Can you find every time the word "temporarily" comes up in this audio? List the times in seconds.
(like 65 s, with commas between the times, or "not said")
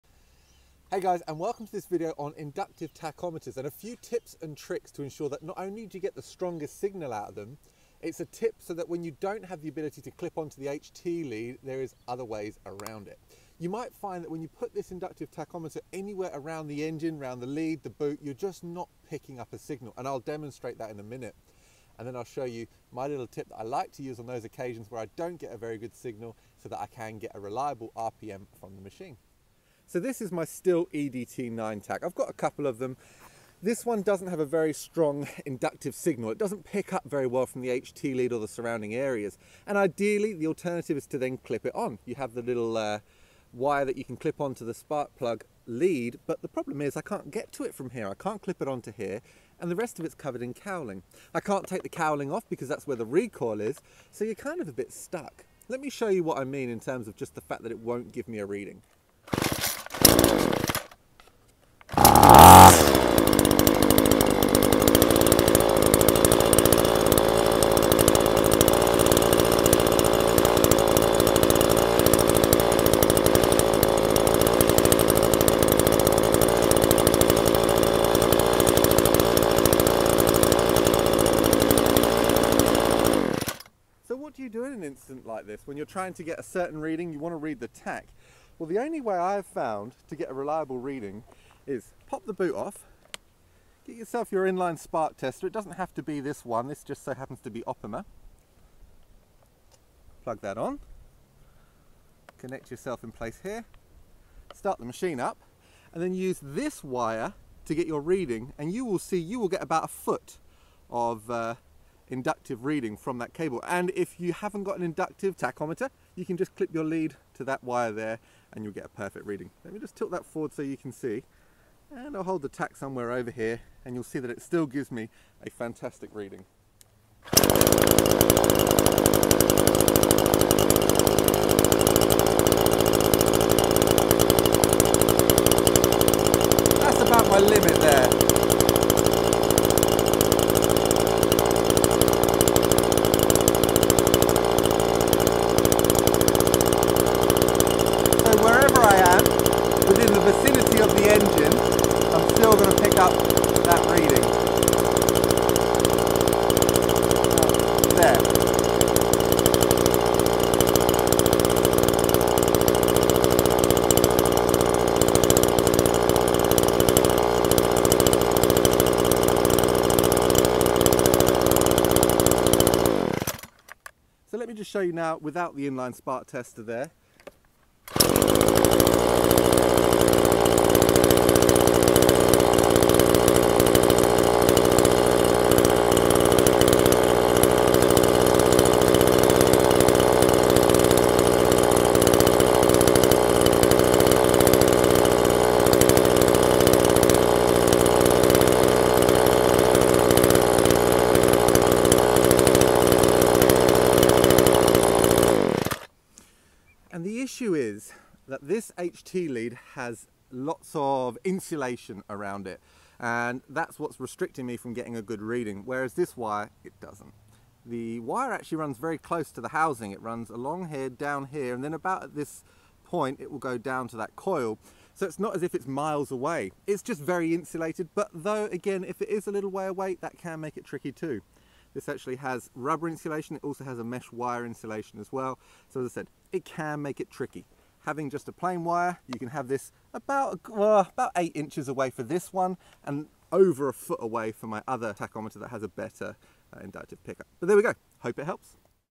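not said.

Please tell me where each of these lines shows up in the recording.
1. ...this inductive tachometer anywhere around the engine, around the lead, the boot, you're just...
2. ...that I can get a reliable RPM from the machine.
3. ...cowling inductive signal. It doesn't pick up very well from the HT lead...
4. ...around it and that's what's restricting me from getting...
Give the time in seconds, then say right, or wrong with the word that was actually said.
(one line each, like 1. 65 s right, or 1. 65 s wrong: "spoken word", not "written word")
1. 14 s right
2. 26 s right
3. 34 s wrong: "strong", not "cowling"
4. 212 s right.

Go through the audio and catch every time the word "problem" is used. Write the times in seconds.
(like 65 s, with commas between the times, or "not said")
46 s.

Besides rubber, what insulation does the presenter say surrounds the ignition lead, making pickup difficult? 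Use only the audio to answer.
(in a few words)
mesh wire.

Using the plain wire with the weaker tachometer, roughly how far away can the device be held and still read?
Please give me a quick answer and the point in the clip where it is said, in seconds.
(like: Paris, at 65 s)
8 inches, at 241 s.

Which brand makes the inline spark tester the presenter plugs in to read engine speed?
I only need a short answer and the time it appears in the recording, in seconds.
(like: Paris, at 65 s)
Opima, at 97 s.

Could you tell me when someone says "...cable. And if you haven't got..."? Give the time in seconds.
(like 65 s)
113 s.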